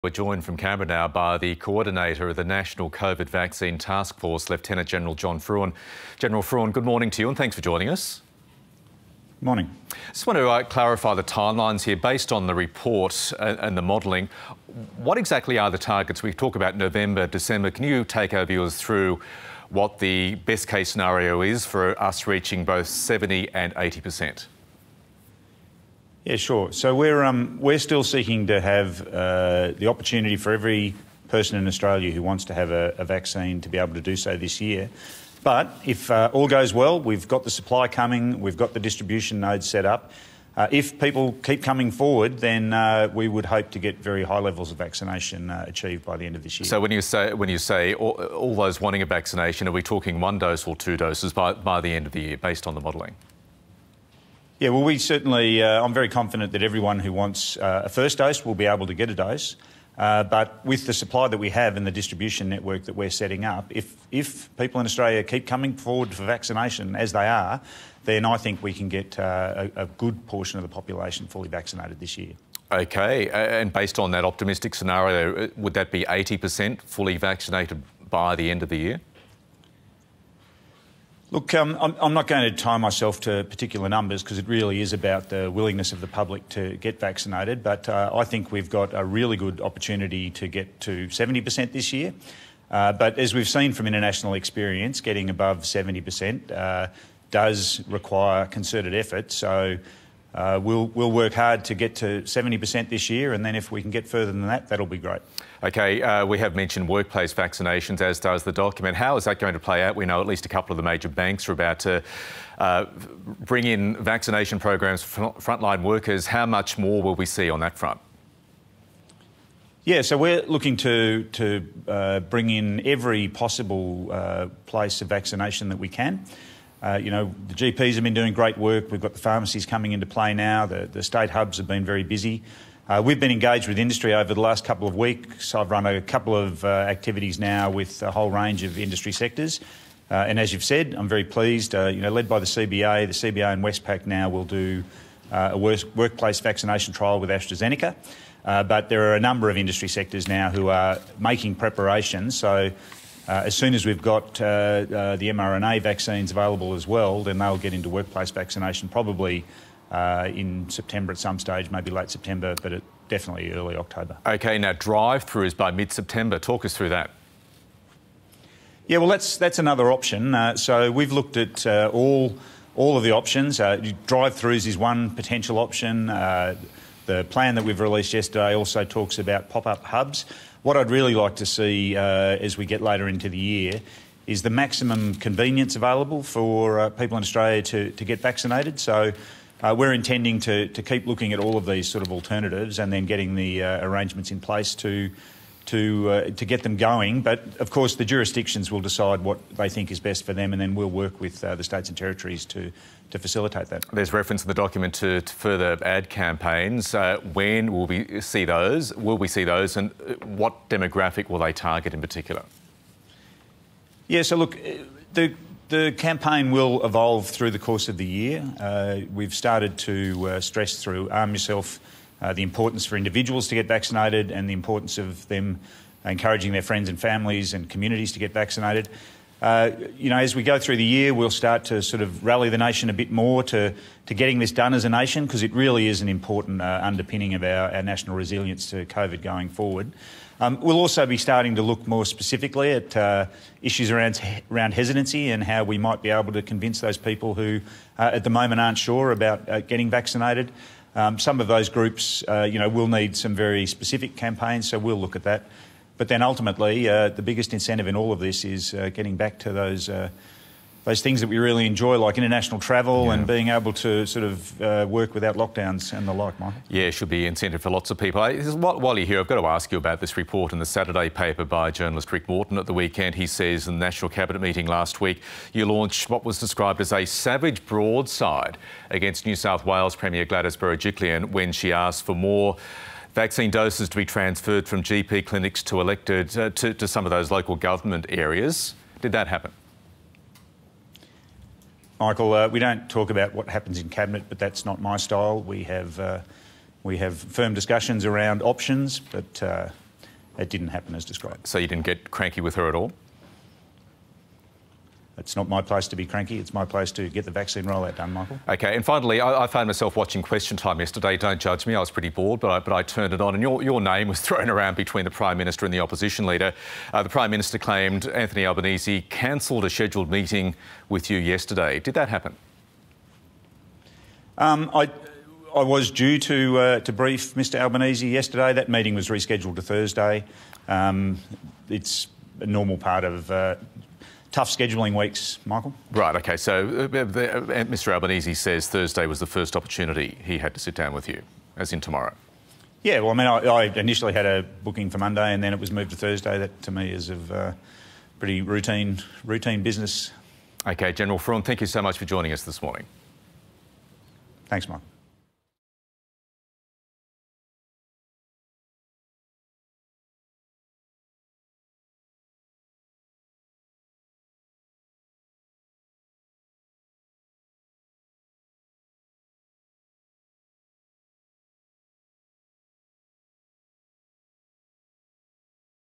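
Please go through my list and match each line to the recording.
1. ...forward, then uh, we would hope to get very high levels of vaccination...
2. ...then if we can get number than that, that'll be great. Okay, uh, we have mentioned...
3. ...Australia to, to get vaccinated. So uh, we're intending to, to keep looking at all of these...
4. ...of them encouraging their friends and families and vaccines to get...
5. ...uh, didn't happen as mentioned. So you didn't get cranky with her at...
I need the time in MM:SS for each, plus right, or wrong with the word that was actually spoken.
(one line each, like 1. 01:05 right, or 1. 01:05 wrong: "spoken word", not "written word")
1. 00:41 right
2. 01:43 wrong: "further", not "number"
3. 03:07 right
4. 03:44 wrong: "communities", not "vaccines"
5. 04:59 wrong: "described", not "mentioned".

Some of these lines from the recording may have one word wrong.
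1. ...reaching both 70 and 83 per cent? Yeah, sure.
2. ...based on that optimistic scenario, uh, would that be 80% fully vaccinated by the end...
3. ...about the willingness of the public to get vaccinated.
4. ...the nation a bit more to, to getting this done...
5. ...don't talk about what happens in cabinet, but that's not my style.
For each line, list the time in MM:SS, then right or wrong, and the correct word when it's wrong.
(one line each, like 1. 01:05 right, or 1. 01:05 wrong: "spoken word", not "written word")
1. 00:22 wrong: "80", not "83"
2. 01:13 right
3. 01:24 right
4. 03:52 right
5. 04:52 right.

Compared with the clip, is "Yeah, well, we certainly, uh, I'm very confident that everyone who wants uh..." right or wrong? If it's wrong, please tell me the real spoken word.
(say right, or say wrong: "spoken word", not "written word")
right.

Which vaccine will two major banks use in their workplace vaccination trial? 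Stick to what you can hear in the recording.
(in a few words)
AstraZeneca.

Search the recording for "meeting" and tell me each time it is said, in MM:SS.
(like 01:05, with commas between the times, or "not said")
04:34, 05:20, 05:28.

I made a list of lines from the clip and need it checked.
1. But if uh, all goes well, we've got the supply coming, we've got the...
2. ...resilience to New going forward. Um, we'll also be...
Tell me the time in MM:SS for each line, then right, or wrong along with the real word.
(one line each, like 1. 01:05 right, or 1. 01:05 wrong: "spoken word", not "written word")
1. 00:35 right
2. 03:58 wrong: "COVID", not "New".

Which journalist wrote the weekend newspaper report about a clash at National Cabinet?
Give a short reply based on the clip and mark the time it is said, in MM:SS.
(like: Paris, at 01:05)
Rick Morton, at 04:32.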